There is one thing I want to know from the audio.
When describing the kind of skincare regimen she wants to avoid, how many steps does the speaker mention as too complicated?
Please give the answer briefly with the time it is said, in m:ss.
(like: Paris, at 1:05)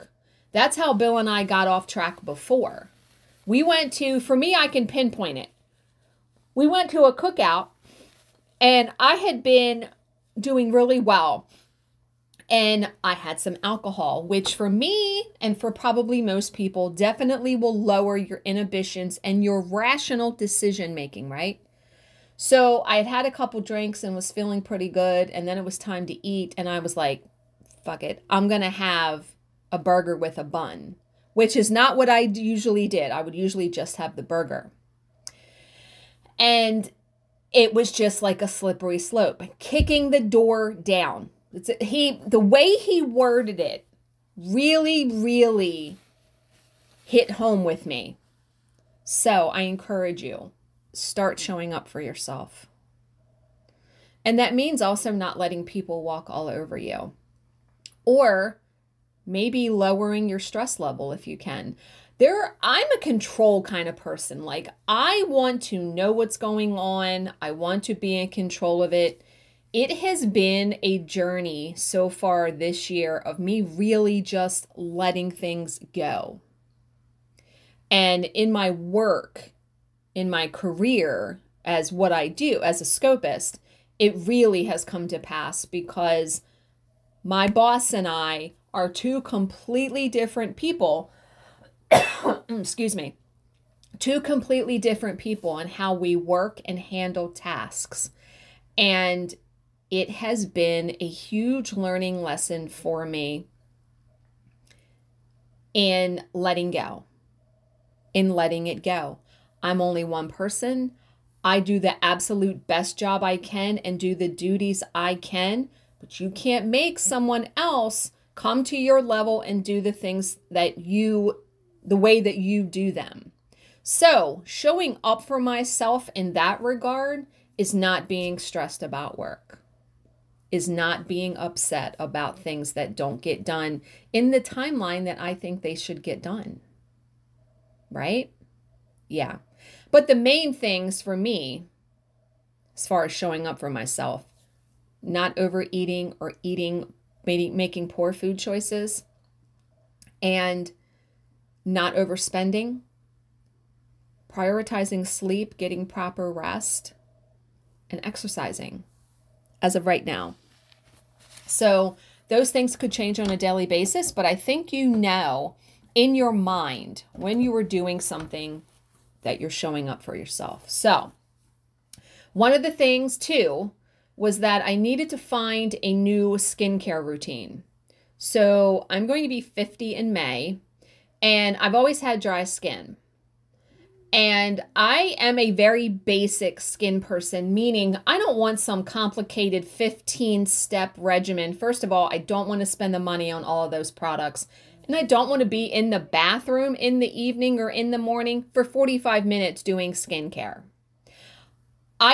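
15, at 3:09.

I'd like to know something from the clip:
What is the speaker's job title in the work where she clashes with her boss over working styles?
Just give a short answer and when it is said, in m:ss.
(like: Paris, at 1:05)
scopist, at 1:22.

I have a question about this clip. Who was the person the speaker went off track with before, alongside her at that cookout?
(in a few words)
Bill.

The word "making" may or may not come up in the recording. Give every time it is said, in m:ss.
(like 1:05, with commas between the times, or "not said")
0:20, 2:27.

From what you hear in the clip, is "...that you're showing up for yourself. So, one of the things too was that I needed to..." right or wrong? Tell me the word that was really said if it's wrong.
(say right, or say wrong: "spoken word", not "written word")
right.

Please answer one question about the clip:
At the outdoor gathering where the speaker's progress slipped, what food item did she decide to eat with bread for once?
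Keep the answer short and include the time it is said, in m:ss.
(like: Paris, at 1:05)
burger with a bun, at 0:29.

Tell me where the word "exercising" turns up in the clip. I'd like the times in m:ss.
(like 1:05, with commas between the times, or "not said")
2:38.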